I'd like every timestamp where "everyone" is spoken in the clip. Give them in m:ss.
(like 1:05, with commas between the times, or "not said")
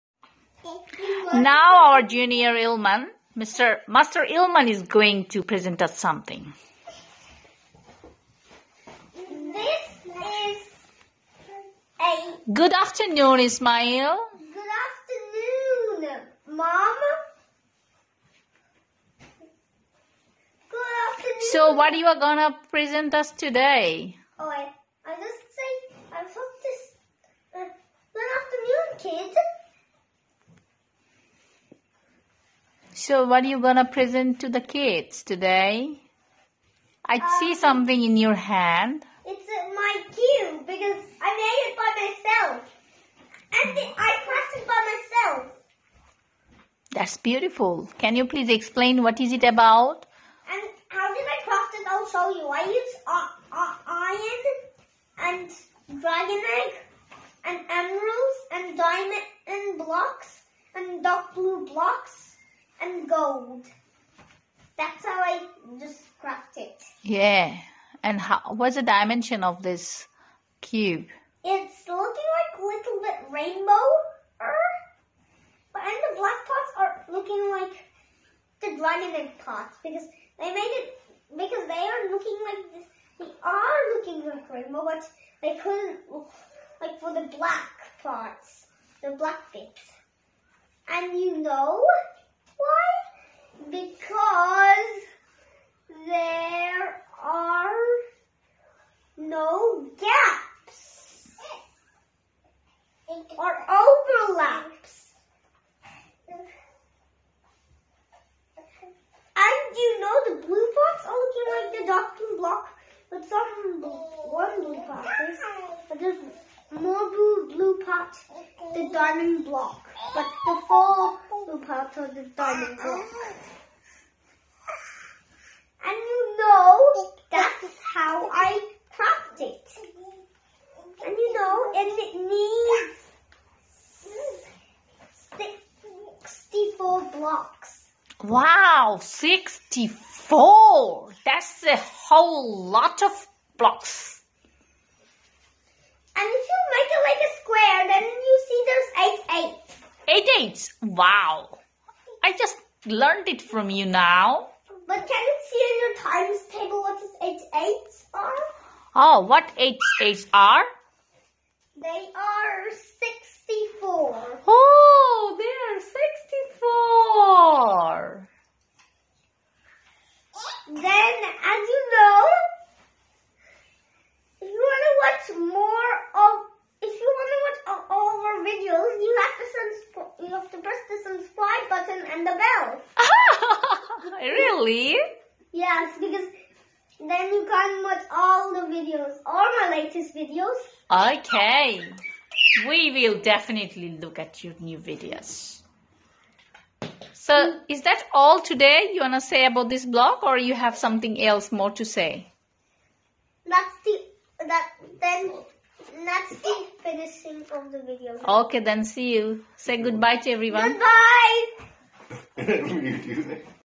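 3:30.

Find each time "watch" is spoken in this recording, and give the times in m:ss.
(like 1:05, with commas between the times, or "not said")
3:07.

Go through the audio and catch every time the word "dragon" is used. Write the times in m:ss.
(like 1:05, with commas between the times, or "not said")
0:56, 1:18.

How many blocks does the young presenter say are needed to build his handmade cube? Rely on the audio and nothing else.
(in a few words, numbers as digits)
64.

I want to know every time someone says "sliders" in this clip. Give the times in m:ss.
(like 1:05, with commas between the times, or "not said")
not said.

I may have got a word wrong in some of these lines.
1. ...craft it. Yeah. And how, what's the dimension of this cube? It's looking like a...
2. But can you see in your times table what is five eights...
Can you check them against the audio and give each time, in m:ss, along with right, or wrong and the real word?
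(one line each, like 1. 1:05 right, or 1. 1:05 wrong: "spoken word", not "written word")
1. 1:06 right
2. 2:34 wrong: "eight", not "five".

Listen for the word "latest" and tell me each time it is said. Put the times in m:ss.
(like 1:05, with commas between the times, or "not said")
3:09.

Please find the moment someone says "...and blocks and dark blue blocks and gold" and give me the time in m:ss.
0:59.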